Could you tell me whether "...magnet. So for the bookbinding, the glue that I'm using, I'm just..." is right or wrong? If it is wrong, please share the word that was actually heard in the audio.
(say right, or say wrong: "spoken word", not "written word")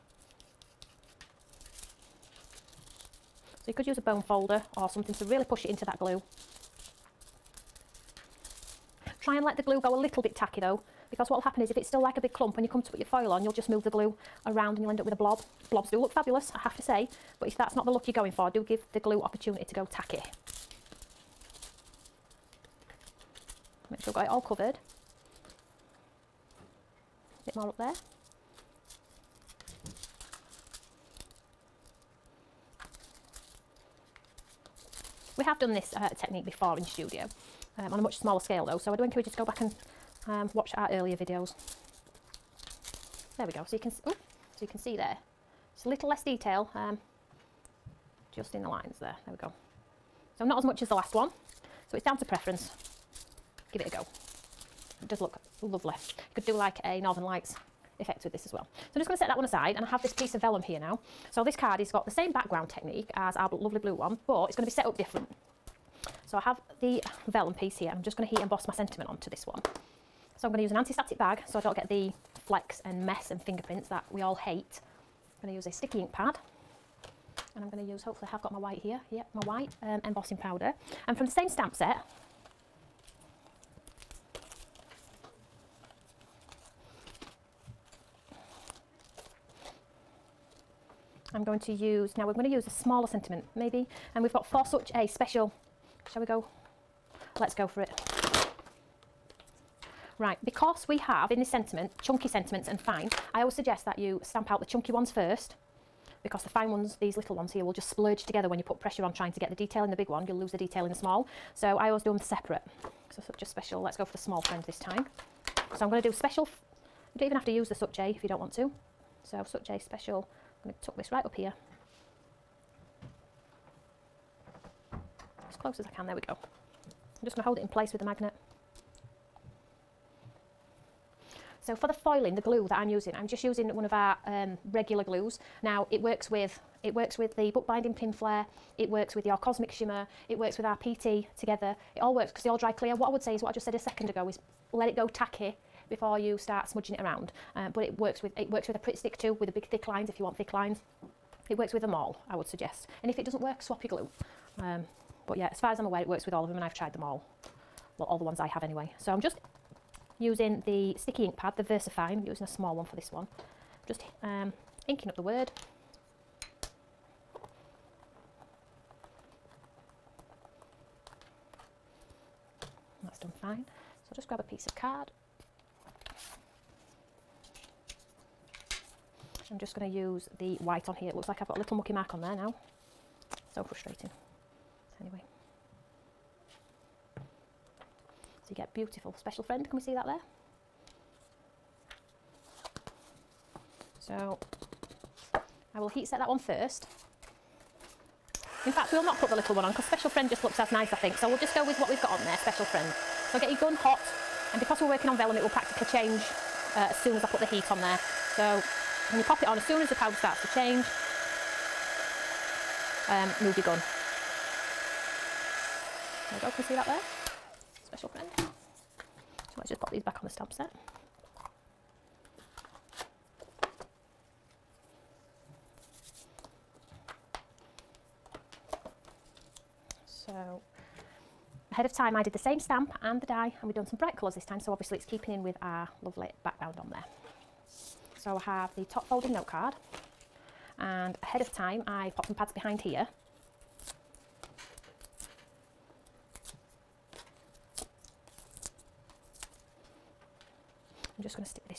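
wrong: "foiling", not "bookbinding".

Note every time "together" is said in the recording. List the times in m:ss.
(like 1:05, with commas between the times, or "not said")
1:48, 2:21.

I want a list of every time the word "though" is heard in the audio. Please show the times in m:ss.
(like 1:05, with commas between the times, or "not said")
0:10, 0:38.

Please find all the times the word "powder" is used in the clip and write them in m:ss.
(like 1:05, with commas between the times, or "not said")
1:20, 3:29.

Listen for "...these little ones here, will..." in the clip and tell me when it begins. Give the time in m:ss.
1:46.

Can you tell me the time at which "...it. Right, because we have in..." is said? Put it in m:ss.
1:37.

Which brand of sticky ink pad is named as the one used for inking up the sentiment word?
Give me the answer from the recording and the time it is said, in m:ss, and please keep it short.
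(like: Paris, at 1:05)
VersaFine, at 2:41.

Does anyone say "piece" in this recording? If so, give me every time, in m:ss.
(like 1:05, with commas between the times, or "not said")
1:00, 1:07, 2:54.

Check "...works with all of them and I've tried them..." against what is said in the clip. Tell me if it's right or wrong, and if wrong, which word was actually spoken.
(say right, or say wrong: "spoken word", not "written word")
right.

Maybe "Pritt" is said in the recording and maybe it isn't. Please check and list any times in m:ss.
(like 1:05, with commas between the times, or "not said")
2:28.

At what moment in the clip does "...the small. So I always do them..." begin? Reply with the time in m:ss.
1:50.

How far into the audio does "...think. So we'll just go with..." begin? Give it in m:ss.
3:20.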